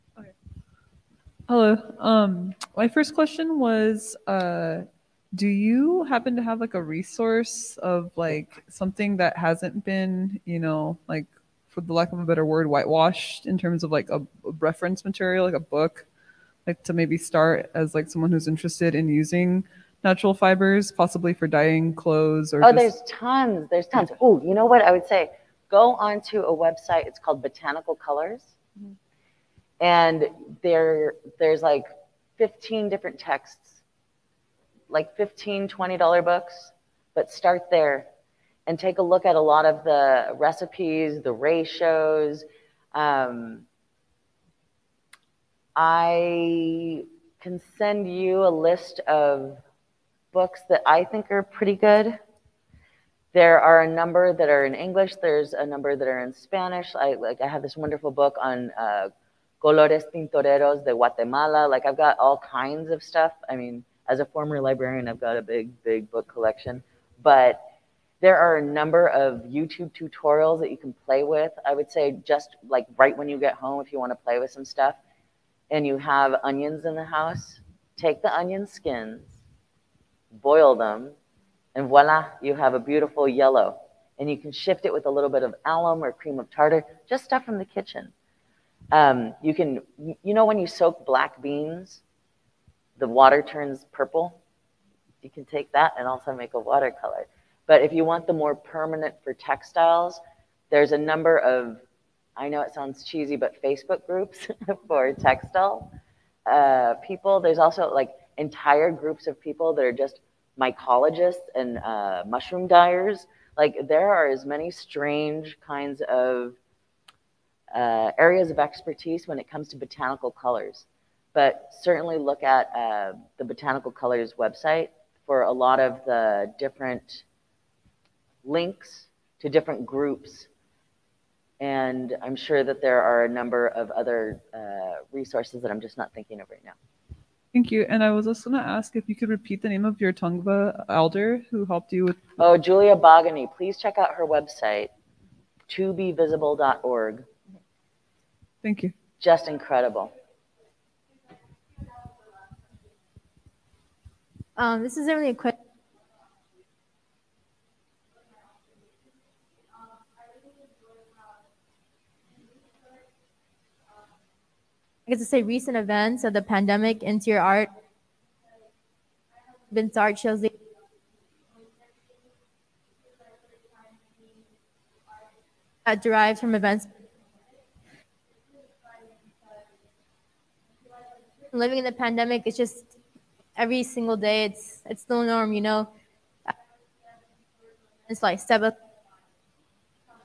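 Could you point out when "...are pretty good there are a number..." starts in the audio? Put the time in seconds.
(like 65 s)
51 s.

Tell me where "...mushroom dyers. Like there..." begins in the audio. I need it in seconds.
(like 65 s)
112 s.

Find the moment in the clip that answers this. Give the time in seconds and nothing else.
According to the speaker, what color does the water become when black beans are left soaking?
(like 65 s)
93 s.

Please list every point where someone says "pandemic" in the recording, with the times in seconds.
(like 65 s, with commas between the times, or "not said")
166 s, 181 s.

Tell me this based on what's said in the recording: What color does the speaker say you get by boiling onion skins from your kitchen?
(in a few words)
Yellow.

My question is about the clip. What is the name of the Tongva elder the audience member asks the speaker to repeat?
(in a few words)
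Julia Bogany.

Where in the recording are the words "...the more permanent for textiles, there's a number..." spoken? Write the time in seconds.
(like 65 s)
98 s.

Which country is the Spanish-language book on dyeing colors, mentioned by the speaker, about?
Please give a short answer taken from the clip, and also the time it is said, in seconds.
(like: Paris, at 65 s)
Guatemala, at 60 s.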